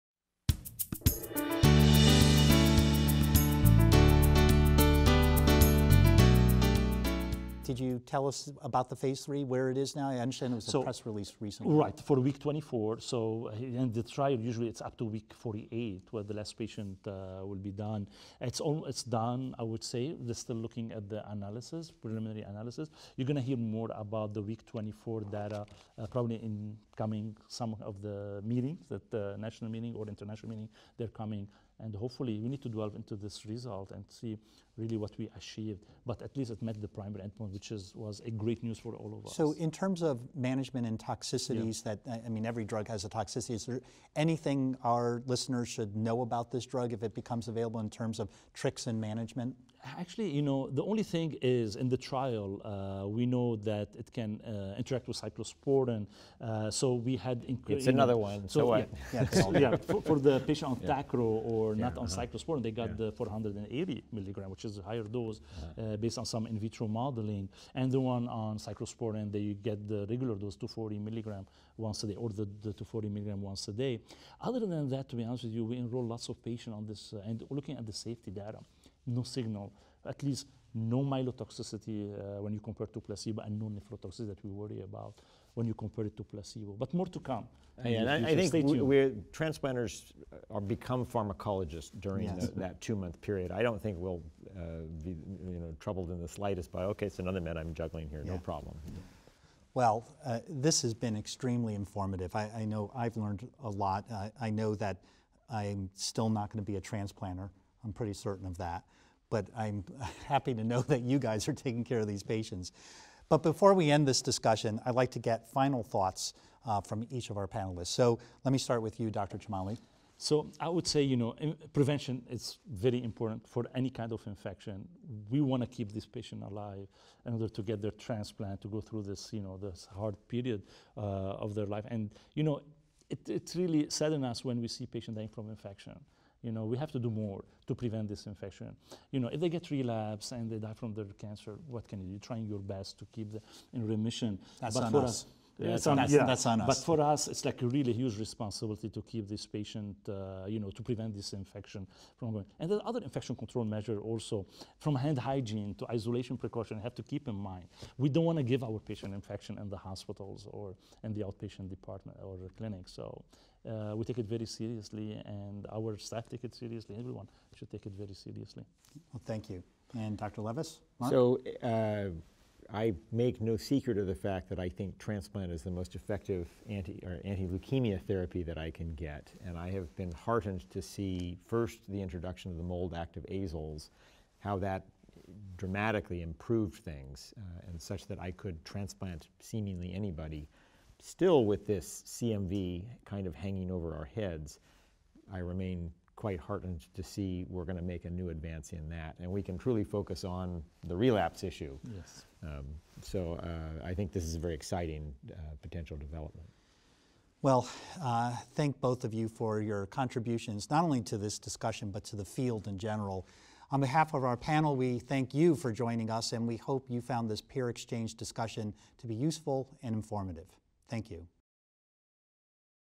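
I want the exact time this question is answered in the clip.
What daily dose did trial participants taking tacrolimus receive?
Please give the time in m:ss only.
1:03.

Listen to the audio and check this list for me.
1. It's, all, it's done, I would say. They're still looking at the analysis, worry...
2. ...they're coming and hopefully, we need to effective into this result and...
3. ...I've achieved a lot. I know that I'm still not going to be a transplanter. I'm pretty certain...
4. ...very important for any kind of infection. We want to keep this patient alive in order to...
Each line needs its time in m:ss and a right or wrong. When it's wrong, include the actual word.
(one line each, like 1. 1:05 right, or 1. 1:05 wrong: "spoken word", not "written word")
1. 0:18 wrong: "preliminary", not "worry"
2. 0:30 wrong: "delve", not "effective"
3. 1:42 wrong: "learned", not "achieved"
4. 2:02 right.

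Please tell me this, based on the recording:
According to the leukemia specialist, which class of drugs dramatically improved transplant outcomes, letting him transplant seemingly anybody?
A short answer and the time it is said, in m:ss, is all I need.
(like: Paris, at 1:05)
Mold active azoles, at 3:02.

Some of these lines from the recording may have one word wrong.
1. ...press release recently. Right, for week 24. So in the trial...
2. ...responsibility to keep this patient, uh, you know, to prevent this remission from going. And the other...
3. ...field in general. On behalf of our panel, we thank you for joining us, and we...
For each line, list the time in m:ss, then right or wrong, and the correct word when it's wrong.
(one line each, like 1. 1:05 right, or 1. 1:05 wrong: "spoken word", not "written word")
1. 0:10 right
2. 2:28 wrong: "infection", not "remission"
3. 3:32 right.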